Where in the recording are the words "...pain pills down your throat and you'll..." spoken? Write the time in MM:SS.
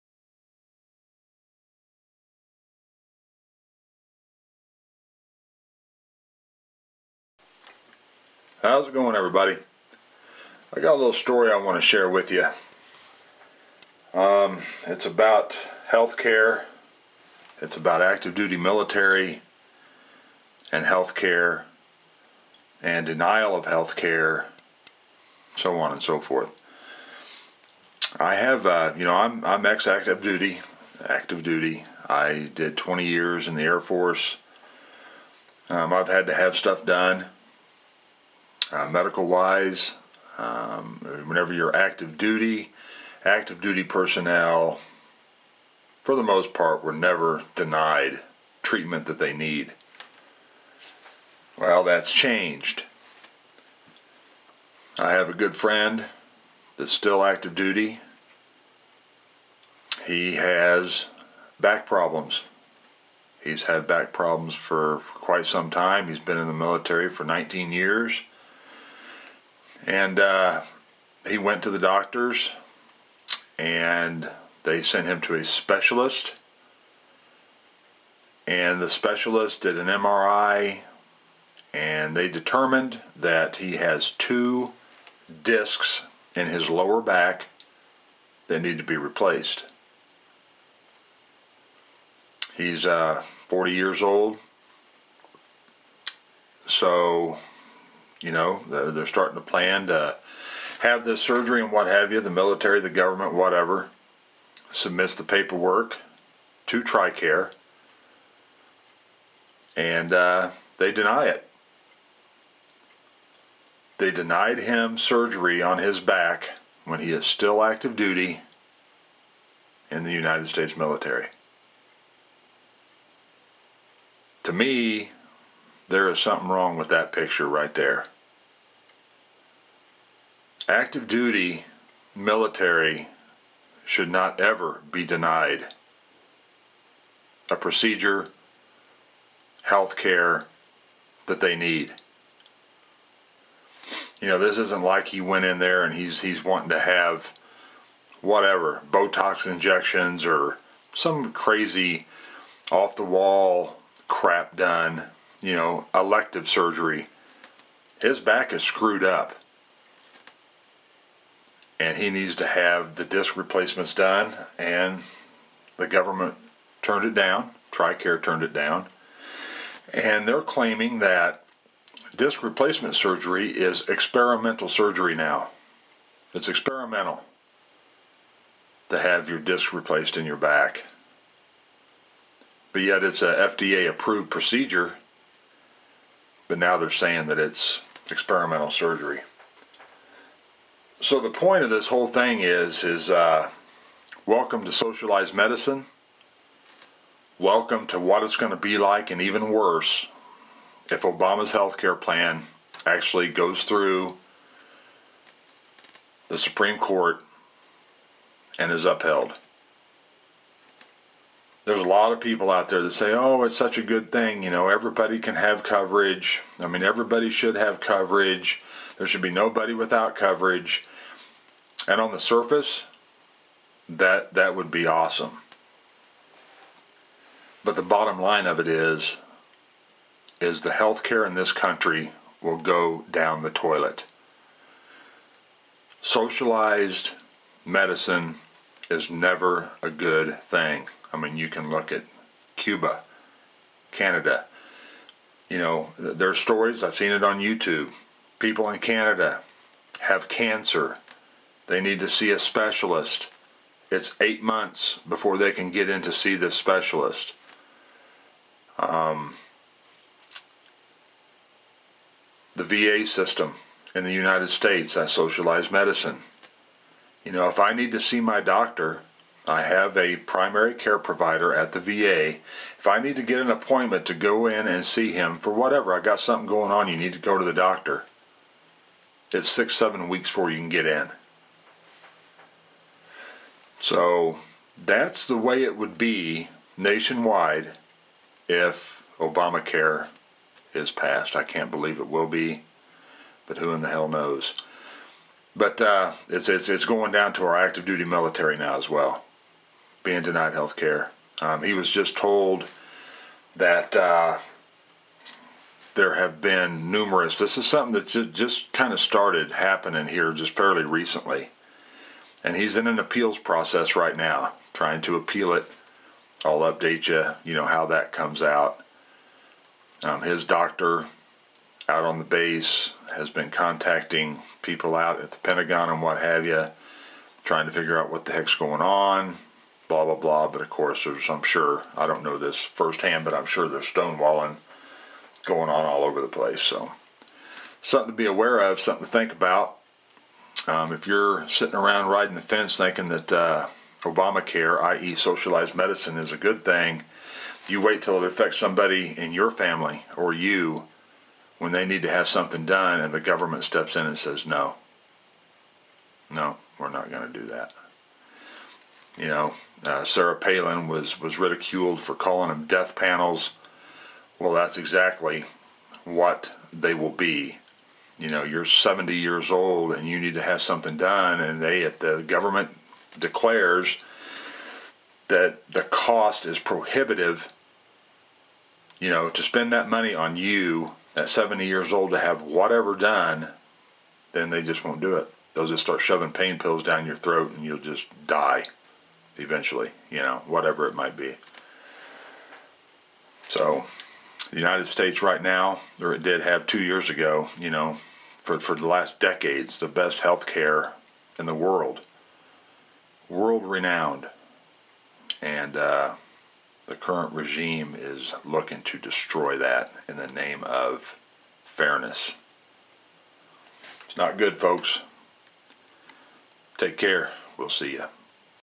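06:26.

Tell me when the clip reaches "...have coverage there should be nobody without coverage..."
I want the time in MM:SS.
03:37.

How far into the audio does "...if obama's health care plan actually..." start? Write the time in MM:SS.
03:20.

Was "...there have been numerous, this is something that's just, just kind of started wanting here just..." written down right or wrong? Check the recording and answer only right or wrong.
wrong.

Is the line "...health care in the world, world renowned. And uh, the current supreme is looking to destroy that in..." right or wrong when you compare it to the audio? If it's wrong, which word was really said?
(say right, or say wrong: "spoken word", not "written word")
wrong: "regime", not "supreme".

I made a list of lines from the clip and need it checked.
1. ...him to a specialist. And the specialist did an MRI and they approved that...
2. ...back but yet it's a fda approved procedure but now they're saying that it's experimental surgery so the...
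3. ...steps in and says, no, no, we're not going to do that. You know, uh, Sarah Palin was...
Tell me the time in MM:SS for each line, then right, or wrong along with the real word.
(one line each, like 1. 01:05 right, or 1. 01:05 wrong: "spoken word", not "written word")
1. 01:15 wrong: "determined", not "approved"
2. 03:00 right
3. 05:53 right.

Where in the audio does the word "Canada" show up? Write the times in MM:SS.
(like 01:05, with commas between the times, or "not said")
04:03, 04:08.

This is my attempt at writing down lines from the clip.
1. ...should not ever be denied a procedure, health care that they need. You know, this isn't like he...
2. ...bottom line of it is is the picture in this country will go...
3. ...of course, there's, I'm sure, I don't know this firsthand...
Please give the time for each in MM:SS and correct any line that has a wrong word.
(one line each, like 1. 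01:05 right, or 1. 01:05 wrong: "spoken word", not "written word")
1. 02:13 right
2. 03:47 wrong: "healthcare", not "picture"
3. 05:30 right.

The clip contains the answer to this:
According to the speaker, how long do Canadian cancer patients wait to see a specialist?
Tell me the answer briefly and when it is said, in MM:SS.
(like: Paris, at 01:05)
8 months, at 04:14.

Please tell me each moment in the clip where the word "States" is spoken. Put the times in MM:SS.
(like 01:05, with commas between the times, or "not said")
02:00, 04:24, 06:34.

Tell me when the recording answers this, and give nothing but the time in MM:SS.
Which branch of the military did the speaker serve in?
00:33.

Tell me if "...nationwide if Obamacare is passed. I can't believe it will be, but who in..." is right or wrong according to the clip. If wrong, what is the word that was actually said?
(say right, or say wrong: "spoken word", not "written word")
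right.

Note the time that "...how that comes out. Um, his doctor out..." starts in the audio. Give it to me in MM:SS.
05:17.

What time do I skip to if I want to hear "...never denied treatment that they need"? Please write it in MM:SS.
00:46.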